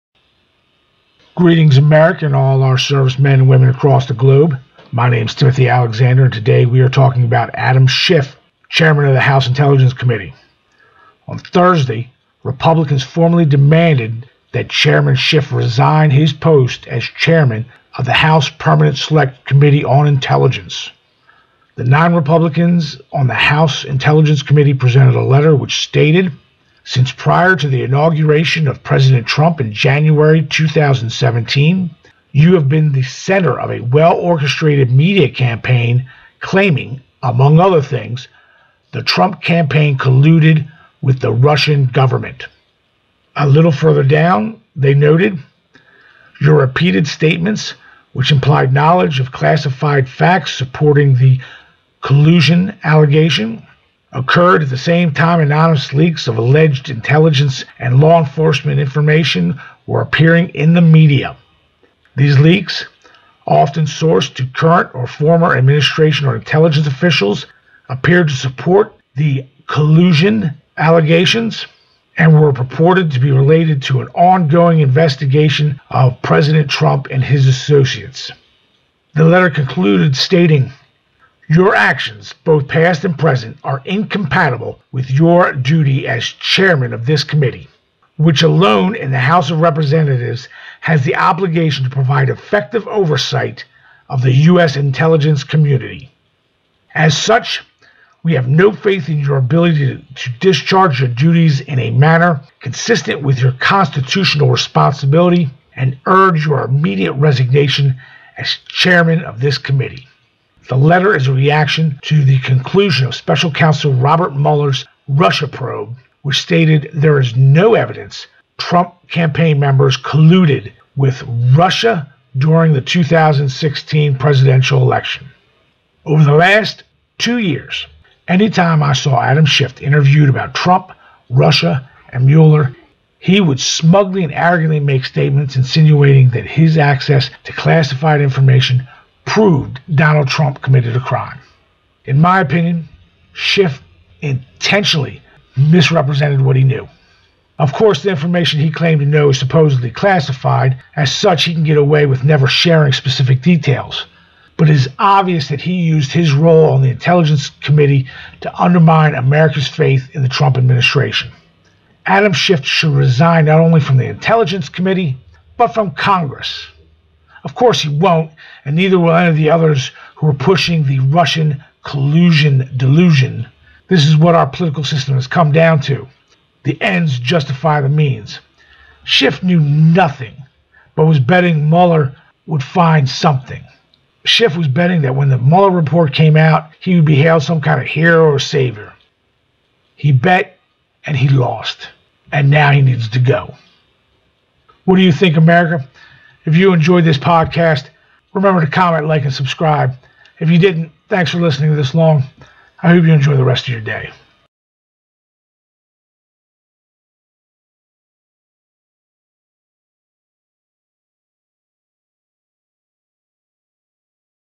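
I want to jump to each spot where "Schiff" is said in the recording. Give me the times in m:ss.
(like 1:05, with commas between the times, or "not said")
0:07, 0:15, 2:09, 2:23, 2:42, 2:59, 3:04.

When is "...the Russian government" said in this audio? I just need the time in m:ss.
0:41.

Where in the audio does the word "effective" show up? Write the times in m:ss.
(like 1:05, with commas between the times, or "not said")
1:32.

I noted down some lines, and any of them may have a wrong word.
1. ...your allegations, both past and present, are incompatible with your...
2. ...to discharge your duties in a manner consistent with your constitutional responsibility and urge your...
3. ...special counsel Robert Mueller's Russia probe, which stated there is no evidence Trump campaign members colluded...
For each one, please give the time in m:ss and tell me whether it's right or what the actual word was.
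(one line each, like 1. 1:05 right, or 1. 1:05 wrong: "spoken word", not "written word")
1. 1:21 wrong: "actions", not "allegations"
2. 1:40 right
3. 1:53 right.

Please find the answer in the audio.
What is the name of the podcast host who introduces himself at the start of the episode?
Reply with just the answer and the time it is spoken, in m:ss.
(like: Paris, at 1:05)
Timothy Alexander, at 0:05.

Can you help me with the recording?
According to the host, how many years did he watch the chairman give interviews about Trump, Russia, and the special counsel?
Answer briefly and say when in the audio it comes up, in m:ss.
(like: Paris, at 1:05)
2, at 2:07.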